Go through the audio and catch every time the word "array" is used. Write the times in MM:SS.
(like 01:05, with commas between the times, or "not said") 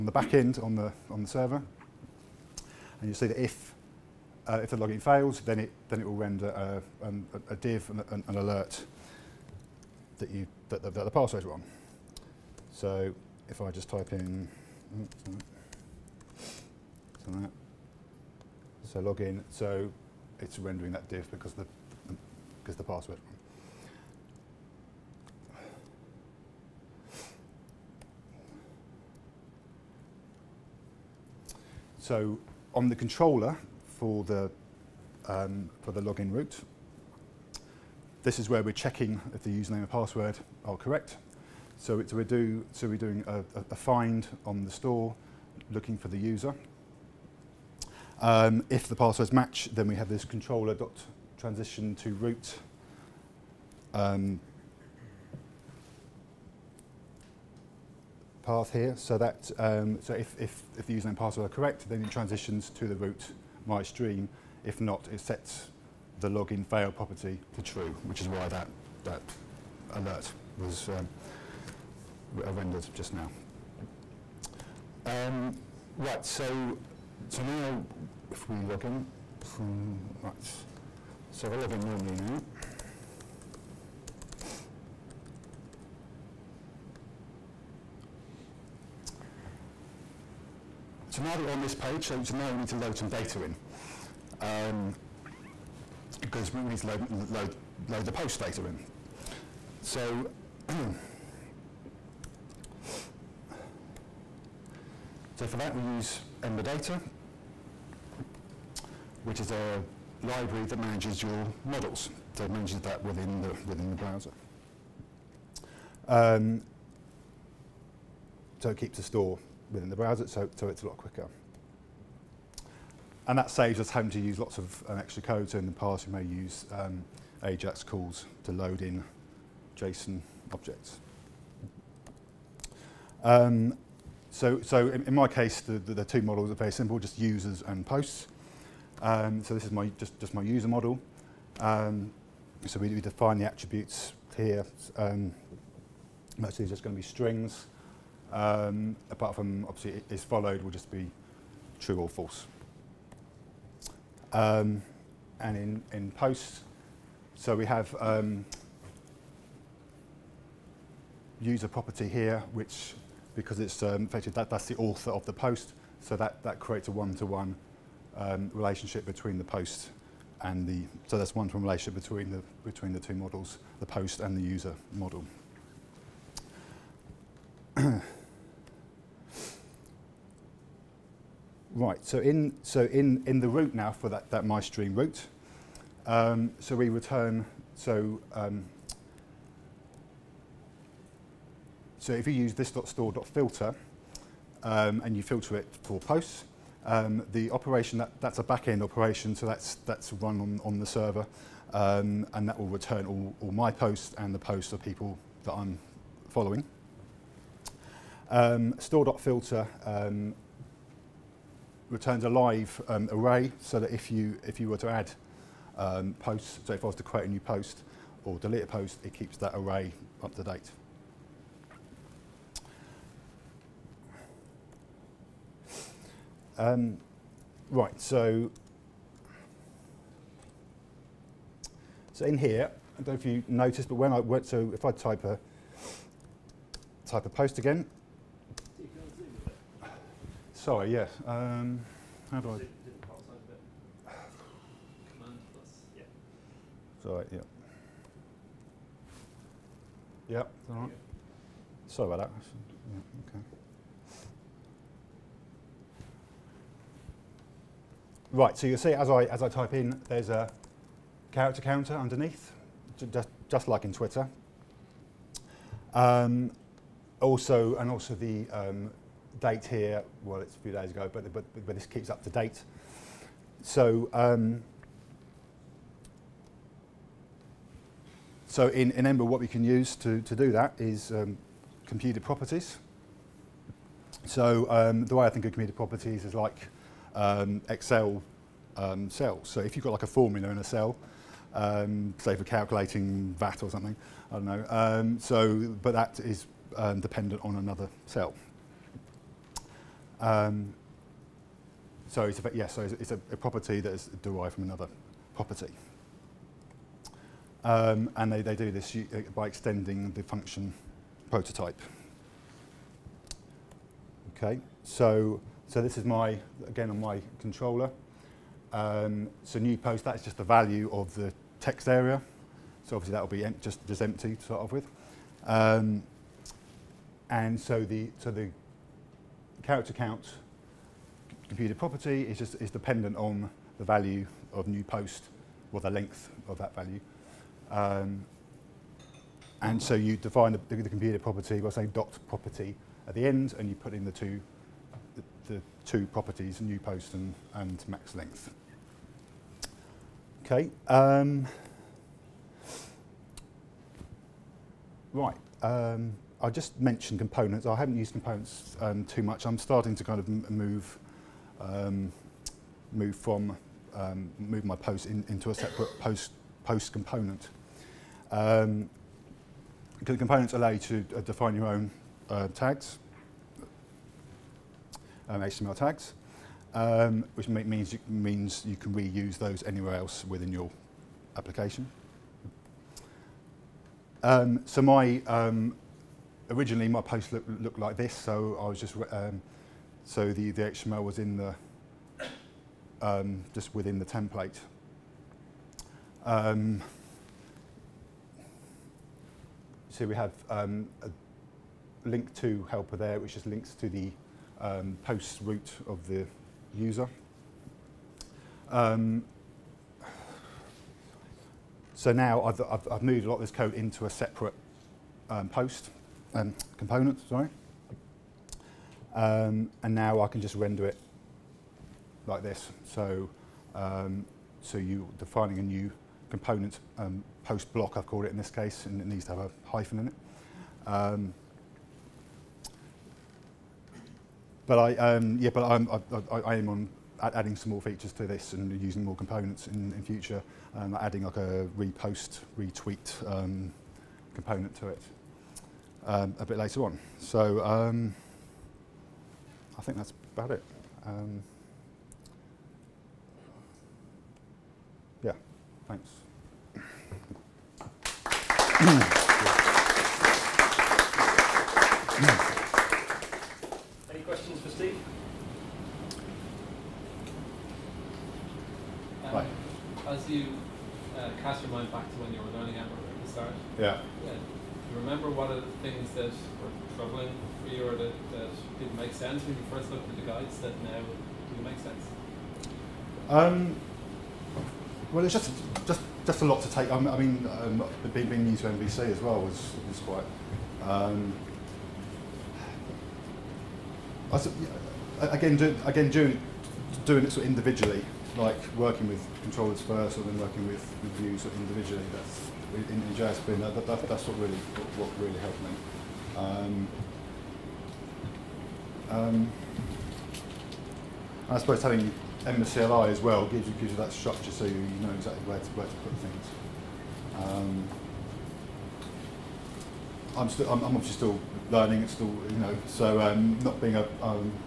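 03:33, 03:39.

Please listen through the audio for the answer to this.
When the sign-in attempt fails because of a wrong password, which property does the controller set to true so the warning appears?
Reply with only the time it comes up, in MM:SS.
01:06.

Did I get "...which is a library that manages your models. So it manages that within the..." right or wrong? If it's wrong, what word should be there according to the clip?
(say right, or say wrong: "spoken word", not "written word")
right.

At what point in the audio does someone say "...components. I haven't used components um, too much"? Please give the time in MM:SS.
05:57.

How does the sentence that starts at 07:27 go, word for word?
So um, I think that's about it.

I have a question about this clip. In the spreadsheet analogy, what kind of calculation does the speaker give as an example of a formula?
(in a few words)
VAT.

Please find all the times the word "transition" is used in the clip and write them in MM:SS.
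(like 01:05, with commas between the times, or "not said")
00:51, 01:02.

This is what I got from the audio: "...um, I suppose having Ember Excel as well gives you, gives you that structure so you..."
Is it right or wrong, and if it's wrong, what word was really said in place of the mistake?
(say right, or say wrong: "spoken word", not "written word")
wrong: "CLI", not "Excel".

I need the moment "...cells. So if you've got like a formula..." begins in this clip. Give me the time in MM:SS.
04:49.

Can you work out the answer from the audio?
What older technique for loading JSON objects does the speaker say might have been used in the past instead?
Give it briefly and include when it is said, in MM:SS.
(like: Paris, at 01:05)
AJAX calls, at 02:07.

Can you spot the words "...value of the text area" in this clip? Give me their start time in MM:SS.
05:20.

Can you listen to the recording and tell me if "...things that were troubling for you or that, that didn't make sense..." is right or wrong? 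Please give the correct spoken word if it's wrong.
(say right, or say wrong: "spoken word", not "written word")
right.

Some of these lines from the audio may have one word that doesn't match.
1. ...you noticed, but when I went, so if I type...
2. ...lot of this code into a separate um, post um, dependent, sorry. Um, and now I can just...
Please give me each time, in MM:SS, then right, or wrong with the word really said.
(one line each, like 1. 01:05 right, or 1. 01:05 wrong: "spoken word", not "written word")
1. 03:53 right
2. 06:53 wrong: "component", not "dependent".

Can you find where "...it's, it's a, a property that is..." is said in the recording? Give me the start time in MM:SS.
05:02.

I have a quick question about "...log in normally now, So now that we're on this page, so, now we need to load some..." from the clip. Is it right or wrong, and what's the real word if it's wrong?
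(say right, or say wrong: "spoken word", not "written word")
right.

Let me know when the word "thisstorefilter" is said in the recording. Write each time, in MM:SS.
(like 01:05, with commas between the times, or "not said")
03:12.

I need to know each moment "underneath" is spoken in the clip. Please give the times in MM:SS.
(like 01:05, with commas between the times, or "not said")
04:21.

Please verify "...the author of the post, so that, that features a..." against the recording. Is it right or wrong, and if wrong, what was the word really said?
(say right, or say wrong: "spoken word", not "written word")
wrong: "creates", not "features".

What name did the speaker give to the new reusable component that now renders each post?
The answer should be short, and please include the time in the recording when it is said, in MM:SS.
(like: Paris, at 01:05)
post block, at 07:07.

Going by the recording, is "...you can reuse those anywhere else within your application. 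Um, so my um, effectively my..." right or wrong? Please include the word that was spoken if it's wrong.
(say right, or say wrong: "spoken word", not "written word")
wrong: "originally", not "effectively".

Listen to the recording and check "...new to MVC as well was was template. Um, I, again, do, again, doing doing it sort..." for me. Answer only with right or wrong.
wrong.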